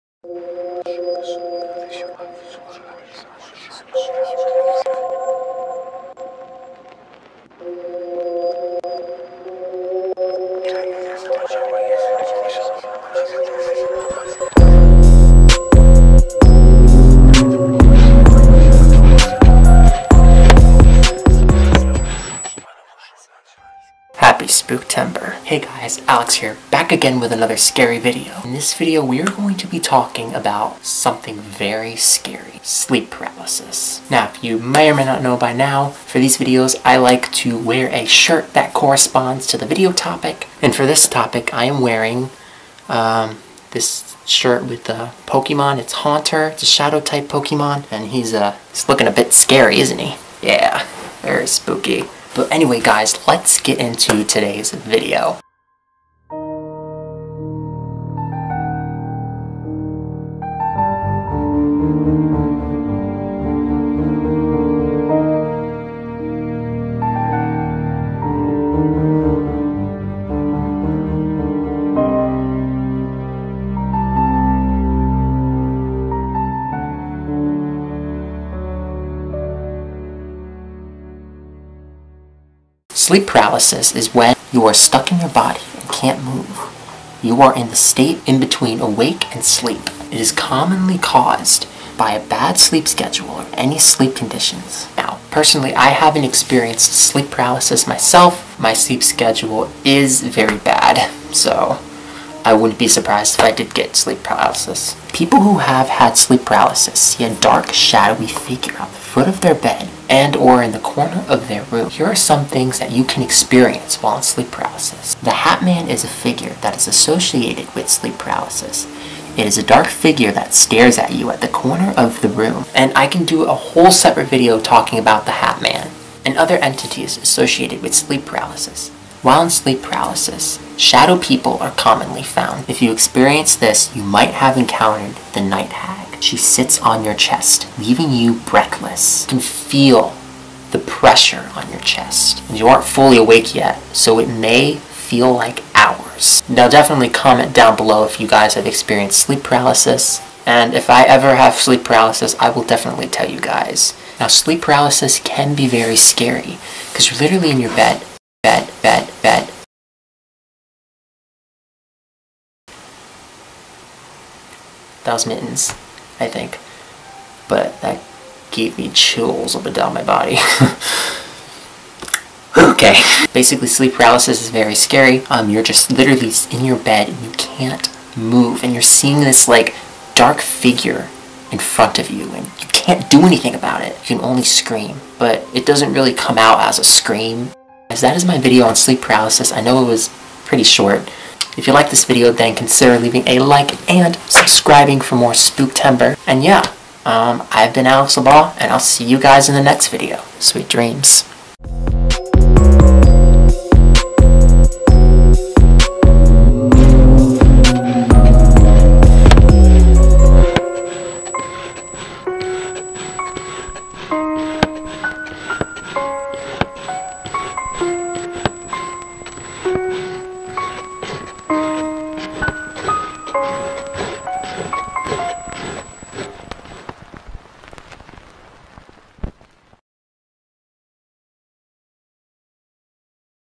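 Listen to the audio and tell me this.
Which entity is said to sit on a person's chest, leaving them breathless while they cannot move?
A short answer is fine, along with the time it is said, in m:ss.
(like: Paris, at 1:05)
the night hag, at 2:15.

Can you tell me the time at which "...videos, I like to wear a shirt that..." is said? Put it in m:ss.
0:36.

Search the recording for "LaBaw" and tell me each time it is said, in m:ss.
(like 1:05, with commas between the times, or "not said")
3:18.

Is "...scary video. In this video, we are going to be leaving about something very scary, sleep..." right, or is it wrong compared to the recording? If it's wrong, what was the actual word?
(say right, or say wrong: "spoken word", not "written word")
wrong: "talking", not "leaving".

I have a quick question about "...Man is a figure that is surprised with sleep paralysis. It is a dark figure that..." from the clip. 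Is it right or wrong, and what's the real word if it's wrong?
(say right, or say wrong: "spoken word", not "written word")
wrong: "associated", not "surprised".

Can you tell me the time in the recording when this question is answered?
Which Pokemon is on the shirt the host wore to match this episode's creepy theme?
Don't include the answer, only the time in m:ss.
0:45.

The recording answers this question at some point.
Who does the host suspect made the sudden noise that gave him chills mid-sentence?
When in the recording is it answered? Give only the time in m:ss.
2:45.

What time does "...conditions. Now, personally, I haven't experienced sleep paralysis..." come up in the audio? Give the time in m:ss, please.
1:34.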